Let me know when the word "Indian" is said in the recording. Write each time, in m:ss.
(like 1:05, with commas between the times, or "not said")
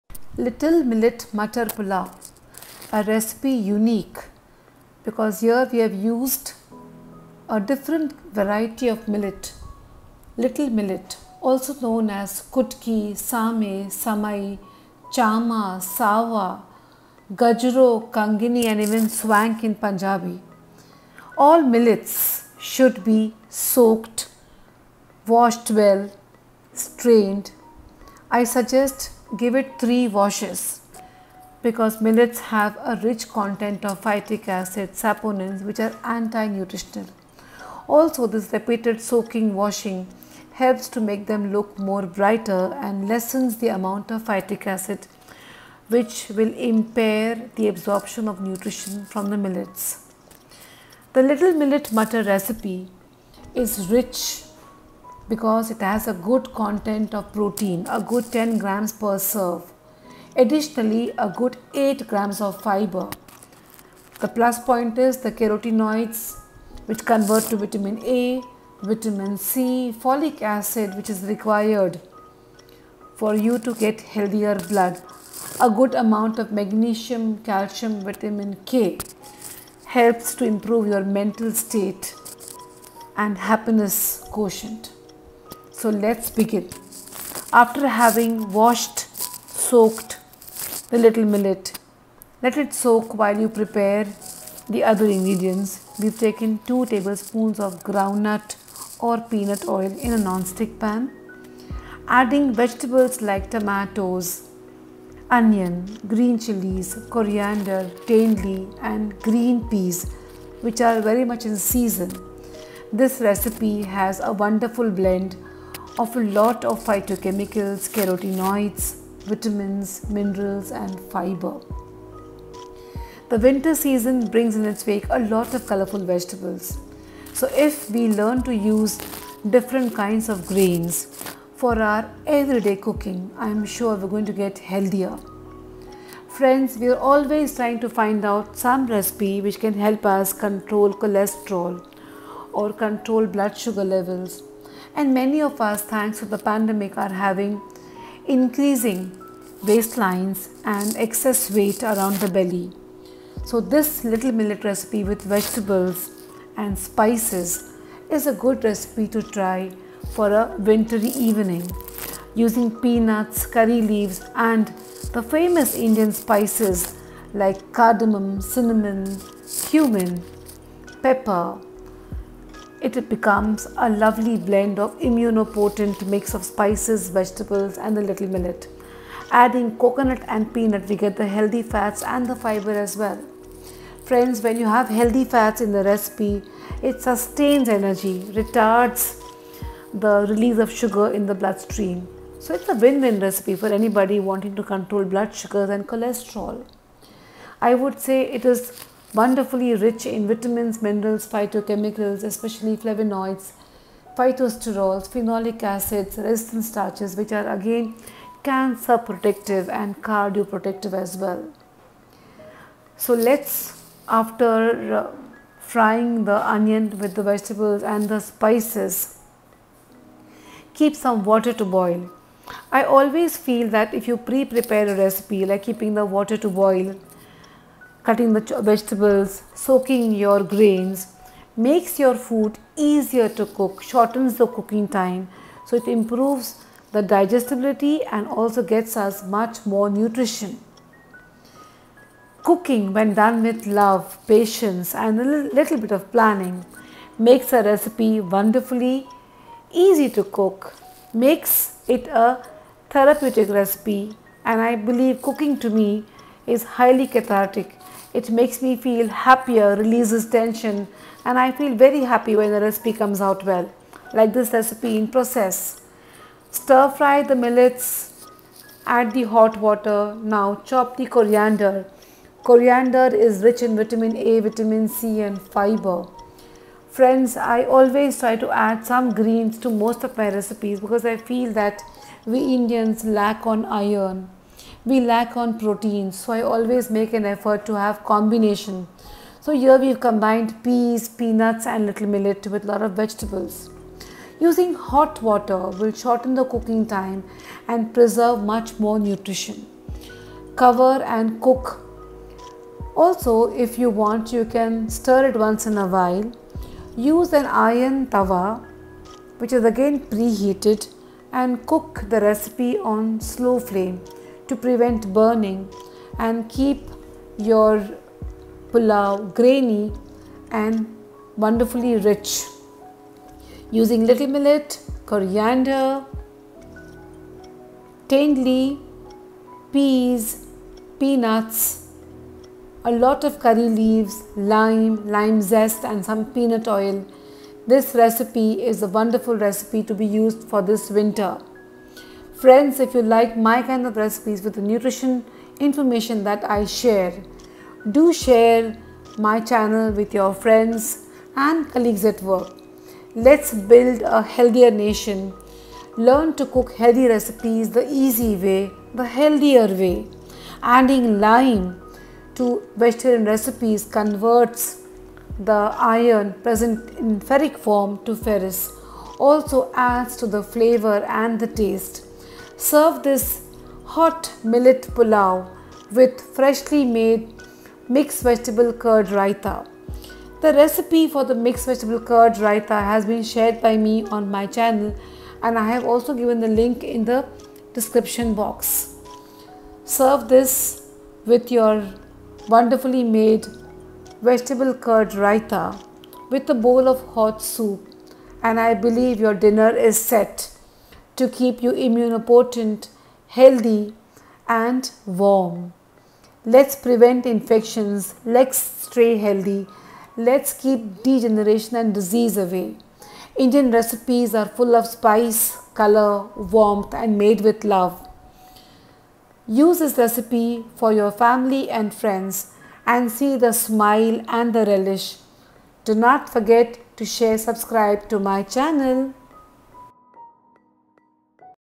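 2:45, 4:42, 6:53.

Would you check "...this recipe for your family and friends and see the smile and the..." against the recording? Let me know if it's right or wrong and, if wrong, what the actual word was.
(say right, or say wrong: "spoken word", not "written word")
right.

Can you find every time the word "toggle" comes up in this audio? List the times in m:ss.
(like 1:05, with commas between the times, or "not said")
not said.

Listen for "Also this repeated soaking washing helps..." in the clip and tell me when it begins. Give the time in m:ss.
0:37.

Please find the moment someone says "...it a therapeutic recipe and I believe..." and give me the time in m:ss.
4:11.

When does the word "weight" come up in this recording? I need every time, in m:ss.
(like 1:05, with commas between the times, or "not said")
2:31.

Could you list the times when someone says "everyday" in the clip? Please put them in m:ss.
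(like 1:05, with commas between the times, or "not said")
2:12.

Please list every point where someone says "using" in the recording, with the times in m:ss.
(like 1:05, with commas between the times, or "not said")
2:42, 4:54, 5:23.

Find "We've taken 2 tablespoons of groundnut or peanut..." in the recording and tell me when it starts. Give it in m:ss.
1:35.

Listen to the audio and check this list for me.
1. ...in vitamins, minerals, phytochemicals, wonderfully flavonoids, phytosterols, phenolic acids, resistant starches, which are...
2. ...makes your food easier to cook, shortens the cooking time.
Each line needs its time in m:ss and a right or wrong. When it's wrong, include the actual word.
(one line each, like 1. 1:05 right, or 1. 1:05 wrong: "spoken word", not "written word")
1. 3:20 wrong: "especially", not "wonderfully"
2. 3:51 right.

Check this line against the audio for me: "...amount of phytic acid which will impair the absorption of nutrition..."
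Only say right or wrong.
right.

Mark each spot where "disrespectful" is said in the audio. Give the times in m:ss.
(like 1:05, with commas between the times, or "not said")
not said.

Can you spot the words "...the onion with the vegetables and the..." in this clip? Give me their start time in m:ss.
3:36.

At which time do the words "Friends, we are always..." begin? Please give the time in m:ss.
2:16.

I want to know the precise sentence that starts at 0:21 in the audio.
All millets should be soaked, washed well, strained.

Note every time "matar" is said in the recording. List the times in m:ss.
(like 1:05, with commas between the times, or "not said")
0:01, 0:51.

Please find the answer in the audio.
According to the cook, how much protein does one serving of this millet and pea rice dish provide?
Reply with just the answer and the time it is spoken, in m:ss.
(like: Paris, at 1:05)
10 grams, at 0:58.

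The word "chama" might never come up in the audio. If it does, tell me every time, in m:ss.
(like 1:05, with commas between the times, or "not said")
0:15.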